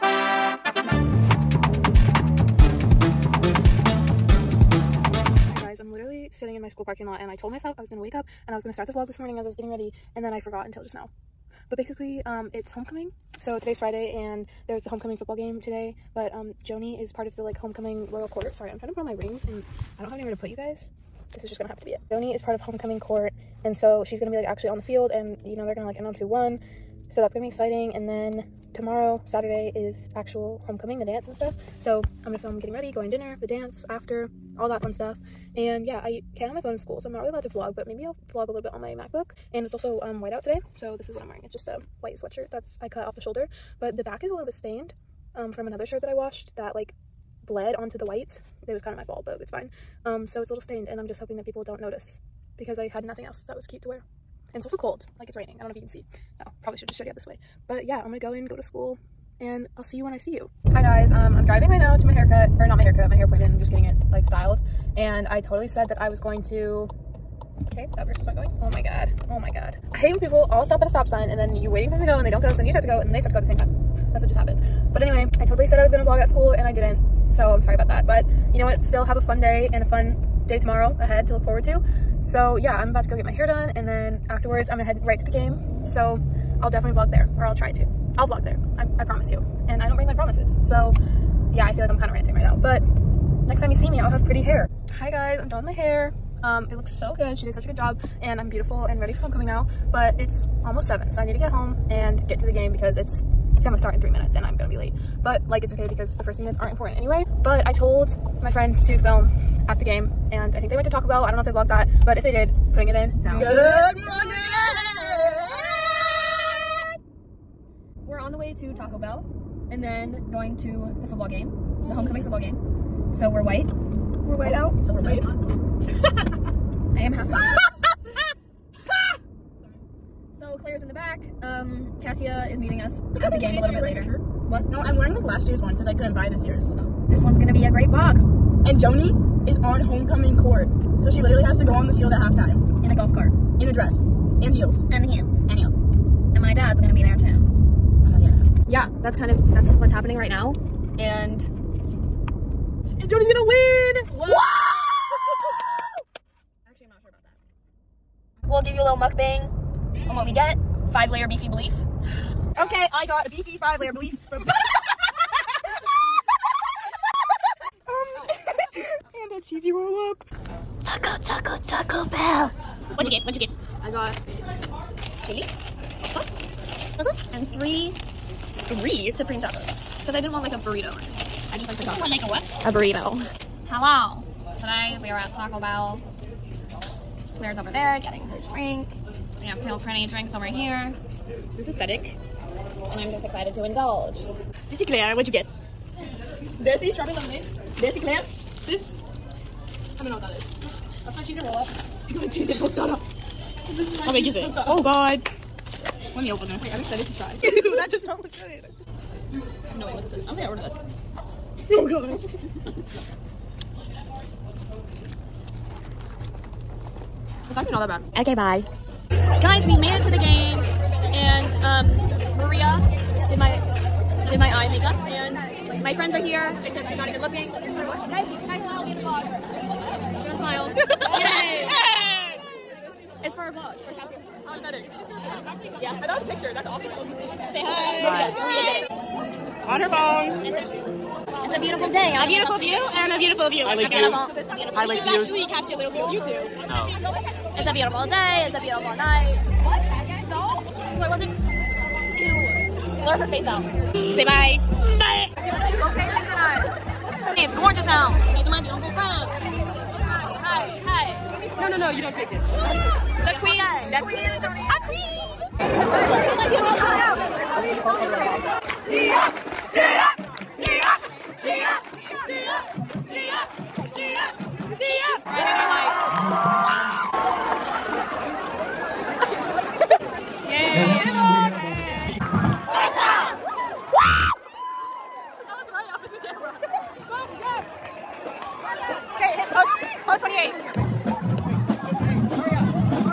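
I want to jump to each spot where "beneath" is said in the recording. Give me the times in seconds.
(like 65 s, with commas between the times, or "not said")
not said.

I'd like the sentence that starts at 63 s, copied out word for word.
I'm just getting it like styled.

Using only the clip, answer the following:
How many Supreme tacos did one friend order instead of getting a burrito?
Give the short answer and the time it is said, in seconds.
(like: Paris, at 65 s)
3, at 178 s.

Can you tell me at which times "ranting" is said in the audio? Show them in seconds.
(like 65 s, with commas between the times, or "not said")
92 s.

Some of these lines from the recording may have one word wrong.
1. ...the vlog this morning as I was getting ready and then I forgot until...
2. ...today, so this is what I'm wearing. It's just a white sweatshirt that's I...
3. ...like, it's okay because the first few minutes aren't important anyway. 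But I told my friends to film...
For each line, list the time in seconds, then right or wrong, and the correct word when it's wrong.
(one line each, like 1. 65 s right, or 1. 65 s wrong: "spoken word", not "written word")
1. 8 s right
2. 40 s right
3. 105 s right.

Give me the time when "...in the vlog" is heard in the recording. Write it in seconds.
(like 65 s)
228 s.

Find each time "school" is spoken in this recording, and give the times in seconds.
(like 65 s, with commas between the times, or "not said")
6 s, 36 s, 58 s, 76 s.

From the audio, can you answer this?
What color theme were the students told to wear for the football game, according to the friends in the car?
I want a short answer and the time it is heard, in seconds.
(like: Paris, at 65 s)
White out, at 123 s.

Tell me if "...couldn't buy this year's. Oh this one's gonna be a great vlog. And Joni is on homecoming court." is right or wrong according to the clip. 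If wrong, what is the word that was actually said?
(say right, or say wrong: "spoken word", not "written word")
right.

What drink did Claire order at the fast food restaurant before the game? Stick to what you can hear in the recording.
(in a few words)
Strawberry lemonade.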